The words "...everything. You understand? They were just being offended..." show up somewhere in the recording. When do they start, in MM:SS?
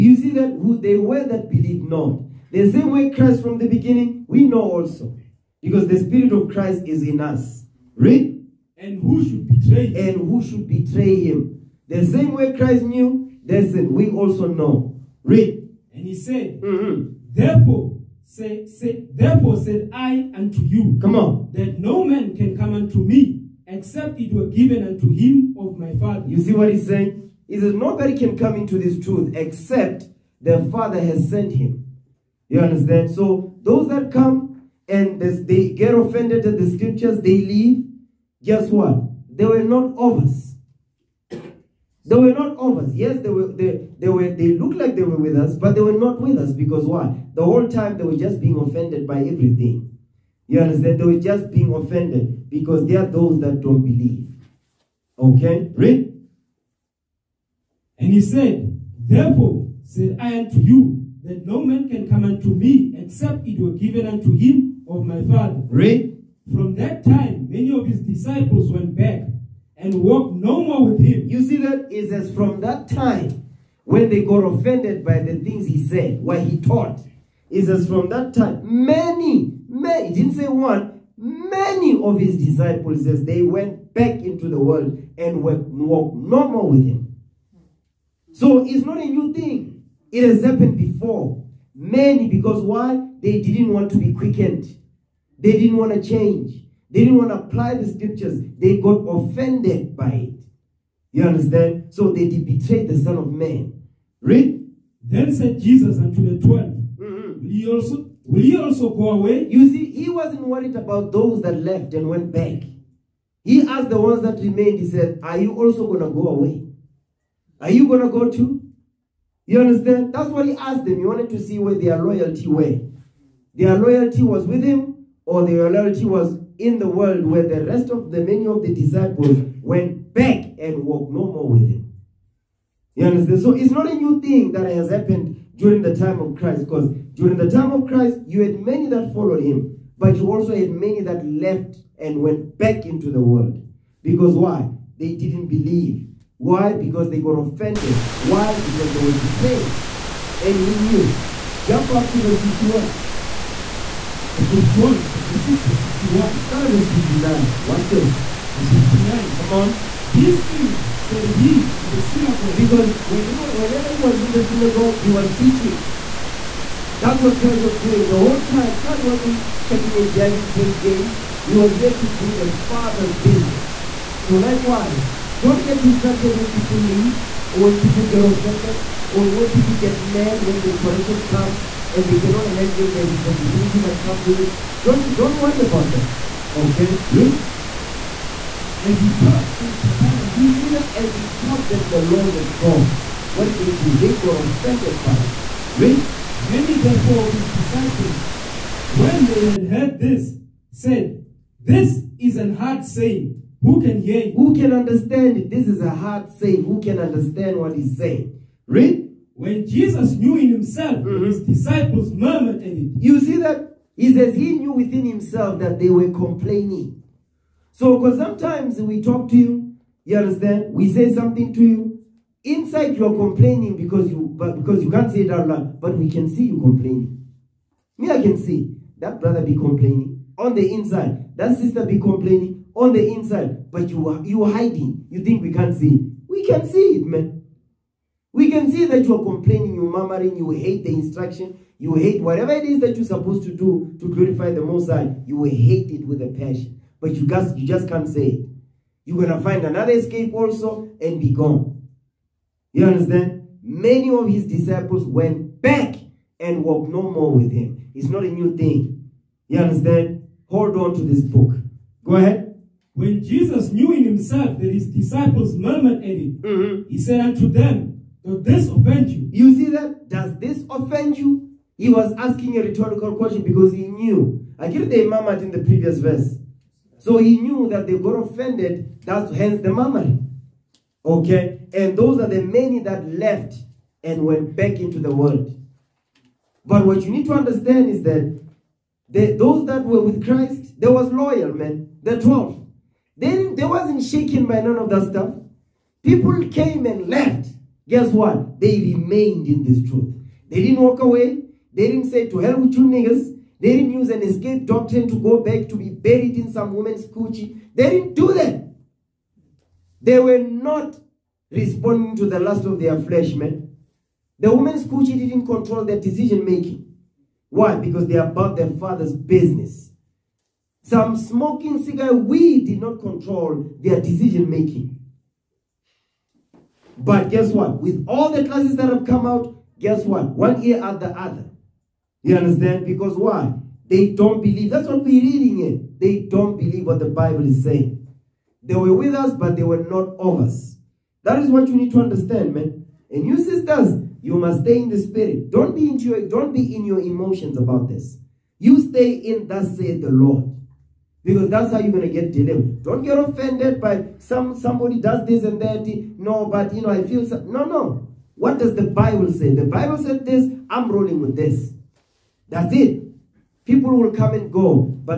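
00:49.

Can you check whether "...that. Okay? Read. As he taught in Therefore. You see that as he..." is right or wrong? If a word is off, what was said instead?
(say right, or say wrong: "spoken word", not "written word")
wrong: "Capernaum", not "Therefore".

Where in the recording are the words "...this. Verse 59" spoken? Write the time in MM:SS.
02:37.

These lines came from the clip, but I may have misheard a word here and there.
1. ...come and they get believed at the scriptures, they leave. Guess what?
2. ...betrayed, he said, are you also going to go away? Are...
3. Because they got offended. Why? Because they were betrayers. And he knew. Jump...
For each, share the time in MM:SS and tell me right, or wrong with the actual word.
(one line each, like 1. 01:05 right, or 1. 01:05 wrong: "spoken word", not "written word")
1. 00:34 wrong: "offended", not "believed"
2. 01:54 wrong: "remained", not "betrayed"
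3. 02:26 right.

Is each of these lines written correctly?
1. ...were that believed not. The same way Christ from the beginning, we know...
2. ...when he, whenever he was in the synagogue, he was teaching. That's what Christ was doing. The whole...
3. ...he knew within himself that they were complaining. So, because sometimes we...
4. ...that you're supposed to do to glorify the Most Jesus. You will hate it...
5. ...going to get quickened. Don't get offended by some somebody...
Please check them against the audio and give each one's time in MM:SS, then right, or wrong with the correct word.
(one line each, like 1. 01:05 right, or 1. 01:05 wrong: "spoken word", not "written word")
1. 00:01 right
2. 02:42 right
3. 03:34 right
4. 04:02 wrong: "High", not "Jesus"
5. 05:51 wrong: "delivered", not "quickened".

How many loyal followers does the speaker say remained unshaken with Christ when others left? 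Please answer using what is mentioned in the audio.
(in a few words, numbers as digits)
12.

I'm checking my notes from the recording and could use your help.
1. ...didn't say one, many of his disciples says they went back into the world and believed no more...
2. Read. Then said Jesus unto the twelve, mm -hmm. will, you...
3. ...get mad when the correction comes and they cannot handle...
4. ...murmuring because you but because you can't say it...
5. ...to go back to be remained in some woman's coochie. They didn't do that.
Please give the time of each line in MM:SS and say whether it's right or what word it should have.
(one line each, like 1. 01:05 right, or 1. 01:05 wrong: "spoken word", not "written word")
1. 01:20 wrong: "walked", not "believed"
2. 01:44 right
3. 02:59 right
4. 03:43 wrong: "complaining", not "murmuring"
5. 05:05 wrong: "buried", not "remained".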